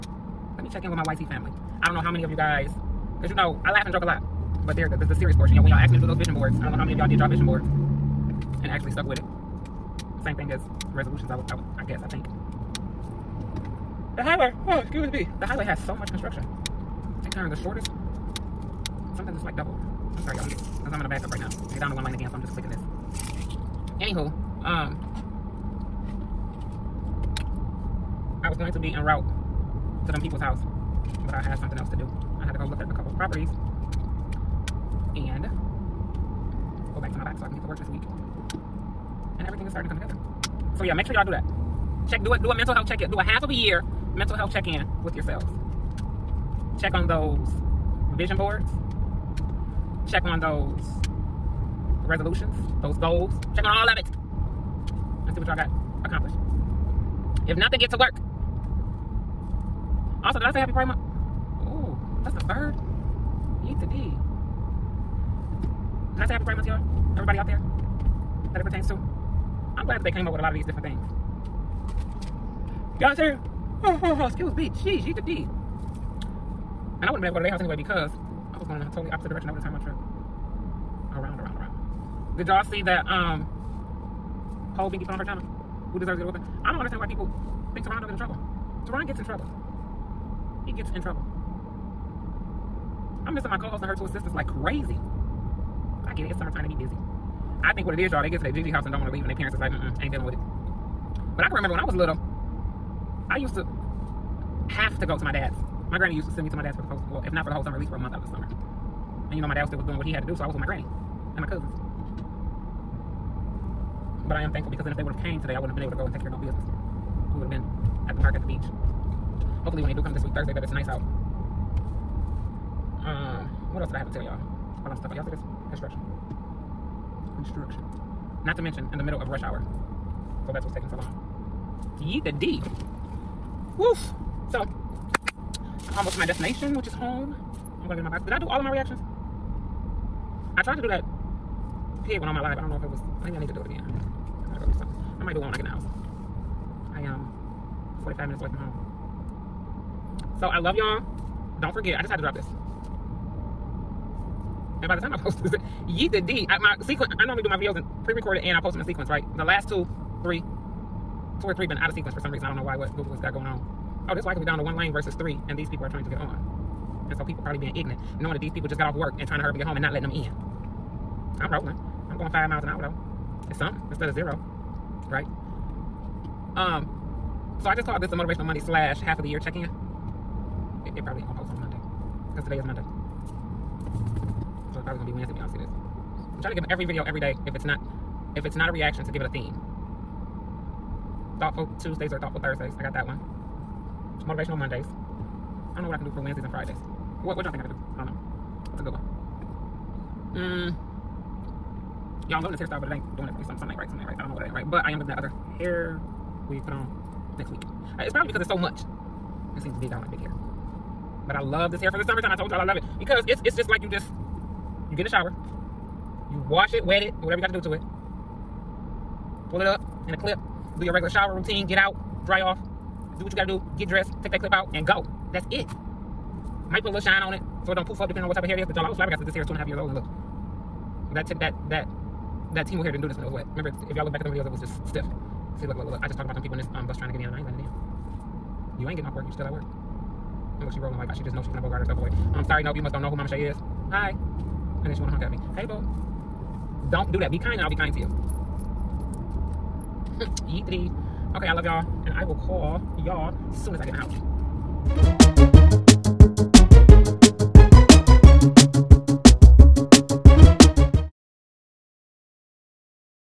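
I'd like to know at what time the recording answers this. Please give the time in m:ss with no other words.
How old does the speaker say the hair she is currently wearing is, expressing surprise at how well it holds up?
3:49.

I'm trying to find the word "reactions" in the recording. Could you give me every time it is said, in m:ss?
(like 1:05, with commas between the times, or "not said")
2:18, 3:08.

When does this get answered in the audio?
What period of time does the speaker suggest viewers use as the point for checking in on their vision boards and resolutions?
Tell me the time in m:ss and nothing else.
0:43.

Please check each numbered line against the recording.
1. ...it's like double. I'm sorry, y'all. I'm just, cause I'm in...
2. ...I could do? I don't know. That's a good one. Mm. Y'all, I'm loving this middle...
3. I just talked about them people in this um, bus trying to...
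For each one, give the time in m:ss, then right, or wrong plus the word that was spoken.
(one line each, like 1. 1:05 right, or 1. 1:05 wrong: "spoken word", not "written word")
1. 0:19 right
2. 3:17 wrong: "hairstyle", not "middle"
3. 3:56 right.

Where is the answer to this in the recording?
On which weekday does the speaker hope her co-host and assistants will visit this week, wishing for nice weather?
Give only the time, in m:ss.
2:00.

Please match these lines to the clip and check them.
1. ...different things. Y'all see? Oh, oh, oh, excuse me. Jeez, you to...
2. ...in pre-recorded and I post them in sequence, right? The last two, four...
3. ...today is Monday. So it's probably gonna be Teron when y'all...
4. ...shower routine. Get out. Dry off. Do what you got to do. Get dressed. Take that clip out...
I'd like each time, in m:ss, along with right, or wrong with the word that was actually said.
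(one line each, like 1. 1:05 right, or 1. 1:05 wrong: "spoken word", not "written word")
1. 1:10 right
2. 2:37 wrong: "three", not "four"
3. 3:02 wrong: "Wednesday", not "Teron"
4. 3:41 right.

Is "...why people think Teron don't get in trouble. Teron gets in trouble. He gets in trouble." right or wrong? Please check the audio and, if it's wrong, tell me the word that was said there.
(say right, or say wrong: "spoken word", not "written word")
right.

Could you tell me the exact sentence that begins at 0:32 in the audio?
I had to go look at a couple of properties.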